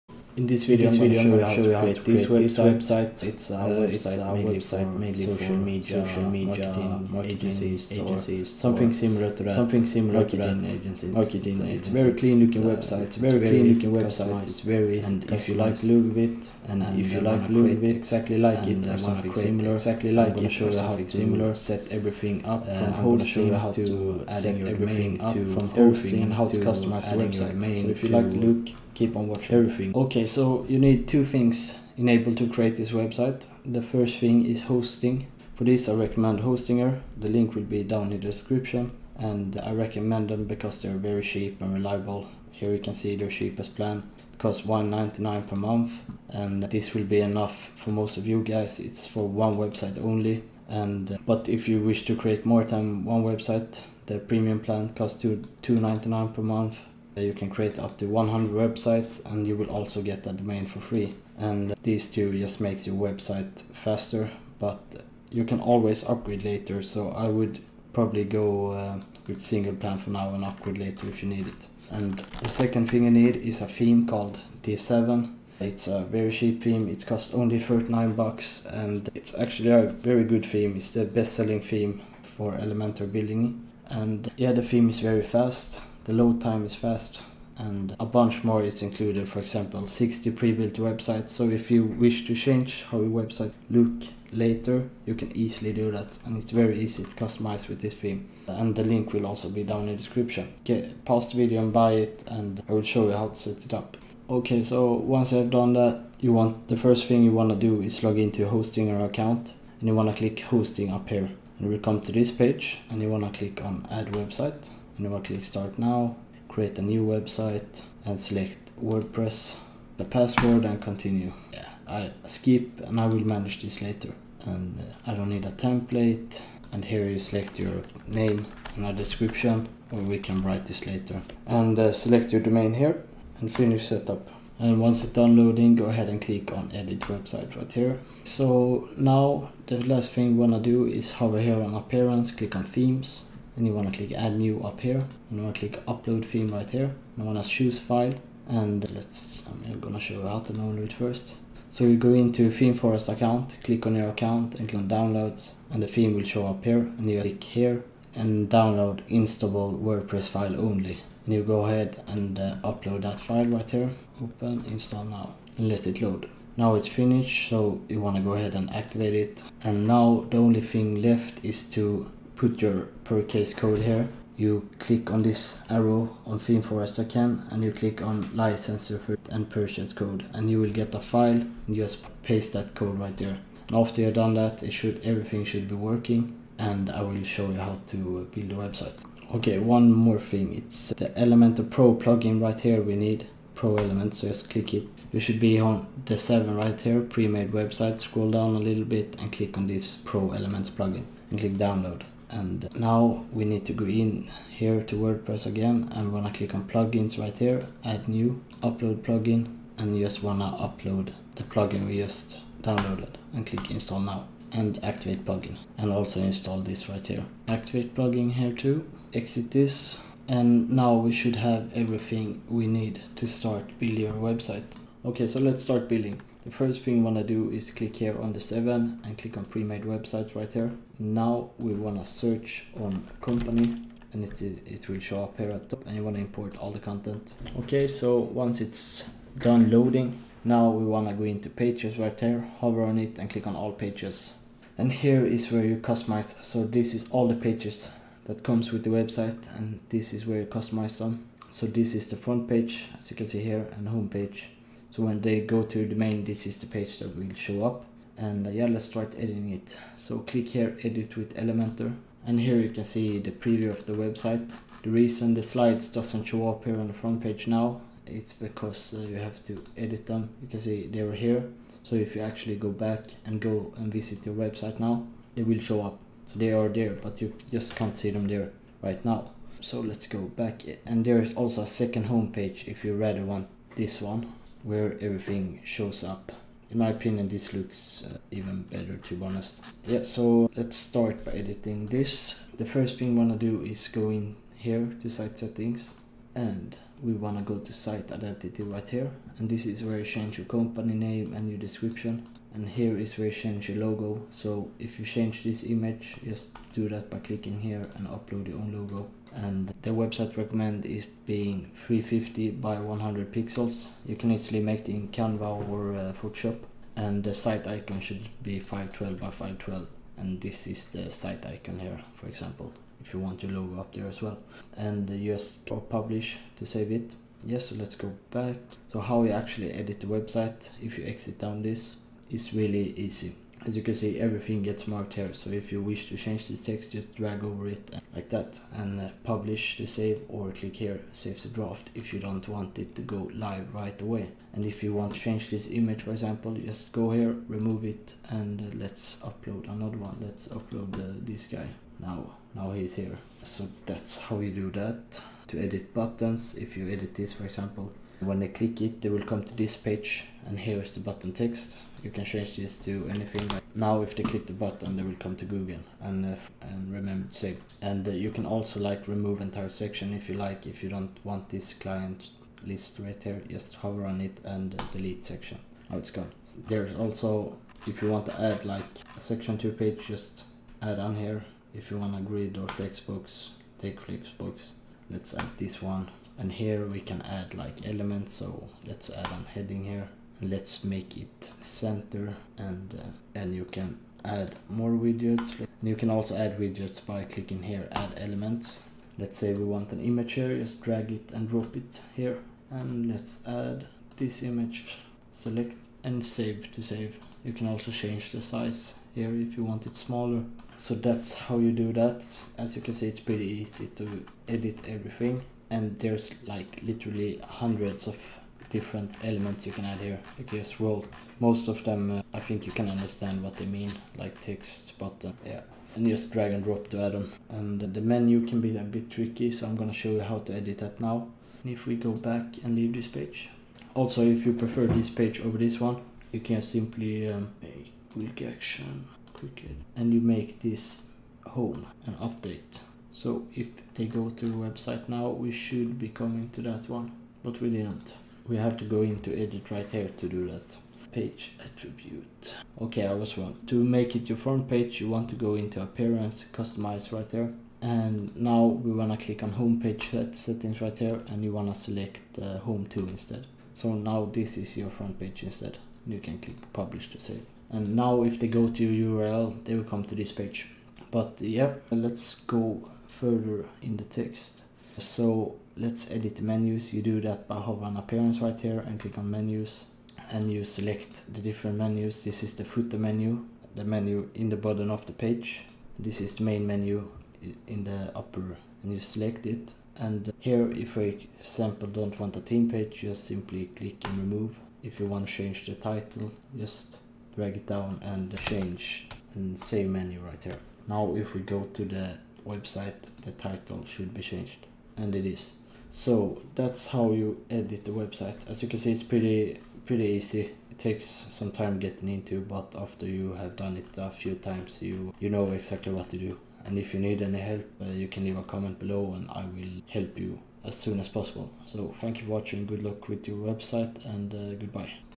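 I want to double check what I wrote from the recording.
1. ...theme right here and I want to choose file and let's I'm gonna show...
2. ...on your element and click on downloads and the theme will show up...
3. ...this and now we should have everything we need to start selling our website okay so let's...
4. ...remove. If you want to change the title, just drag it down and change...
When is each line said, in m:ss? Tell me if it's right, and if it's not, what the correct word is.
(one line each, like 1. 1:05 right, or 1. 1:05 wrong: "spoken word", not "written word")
1. 2:26 right
2. 2:33 wrong: "account", not "element"
3. 3:39 wrong: "building", not "selling"
4. 8:14 right.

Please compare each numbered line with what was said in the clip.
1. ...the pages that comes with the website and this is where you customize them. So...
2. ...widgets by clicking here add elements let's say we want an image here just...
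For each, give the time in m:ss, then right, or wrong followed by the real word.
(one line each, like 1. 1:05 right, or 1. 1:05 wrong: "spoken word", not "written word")
1. 4:07 right
2. 6:36 right.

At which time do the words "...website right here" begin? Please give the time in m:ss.
2:17.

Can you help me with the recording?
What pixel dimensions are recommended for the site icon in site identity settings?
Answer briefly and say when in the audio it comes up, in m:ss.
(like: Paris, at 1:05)
512 by 512, at 5:18.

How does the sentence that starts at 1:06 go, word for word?
So I would probably go uh, with single plan for now and upgrade later if you need it.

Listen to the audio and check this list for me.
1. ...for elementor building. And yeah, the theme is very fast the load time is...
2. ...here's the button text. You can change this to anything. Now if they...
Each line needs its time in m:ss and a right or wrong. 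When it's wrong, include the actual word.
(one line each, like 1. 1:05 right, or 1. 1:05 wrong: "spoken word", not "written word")
1. 1:22 right
2. 6:00 right.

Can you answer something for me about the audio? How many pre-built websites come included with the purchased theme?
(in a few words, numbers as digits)
60.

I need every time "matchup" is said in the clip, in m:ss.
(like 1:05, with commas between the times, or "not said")
not said.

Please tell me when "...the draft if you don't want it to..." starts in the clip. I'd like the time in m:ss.
5:41.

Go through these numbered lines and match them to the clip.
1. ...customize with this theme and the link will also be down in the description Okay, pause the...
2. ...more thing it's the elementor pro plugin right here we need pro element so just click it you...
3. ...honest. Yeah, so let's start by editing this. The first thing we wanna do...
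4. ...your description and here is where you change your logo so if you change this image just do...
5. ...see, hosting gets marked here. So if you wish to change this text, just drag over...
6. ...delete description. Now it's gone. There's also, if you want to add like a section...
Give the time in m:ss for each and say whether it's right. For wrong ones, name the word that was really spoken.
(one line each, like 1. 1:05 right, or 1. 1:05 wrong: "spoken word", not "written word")
1. 1:37 right
2. 3:09 right
3. 4:49 right
4. 5:01 right
5. 5:33 wrong: "everything", not "hosting"
6. 6:14 wrong: "section", not "description".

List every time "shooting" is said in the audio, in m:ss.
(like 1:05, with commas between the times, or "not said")
not said.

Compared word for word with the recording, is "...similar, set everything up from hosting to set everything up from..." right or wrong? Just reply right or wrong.
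right.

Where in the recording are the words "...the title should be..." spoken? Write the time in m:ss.
8:23.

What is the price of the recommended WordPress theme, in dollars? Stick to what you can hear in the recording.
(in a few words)
39.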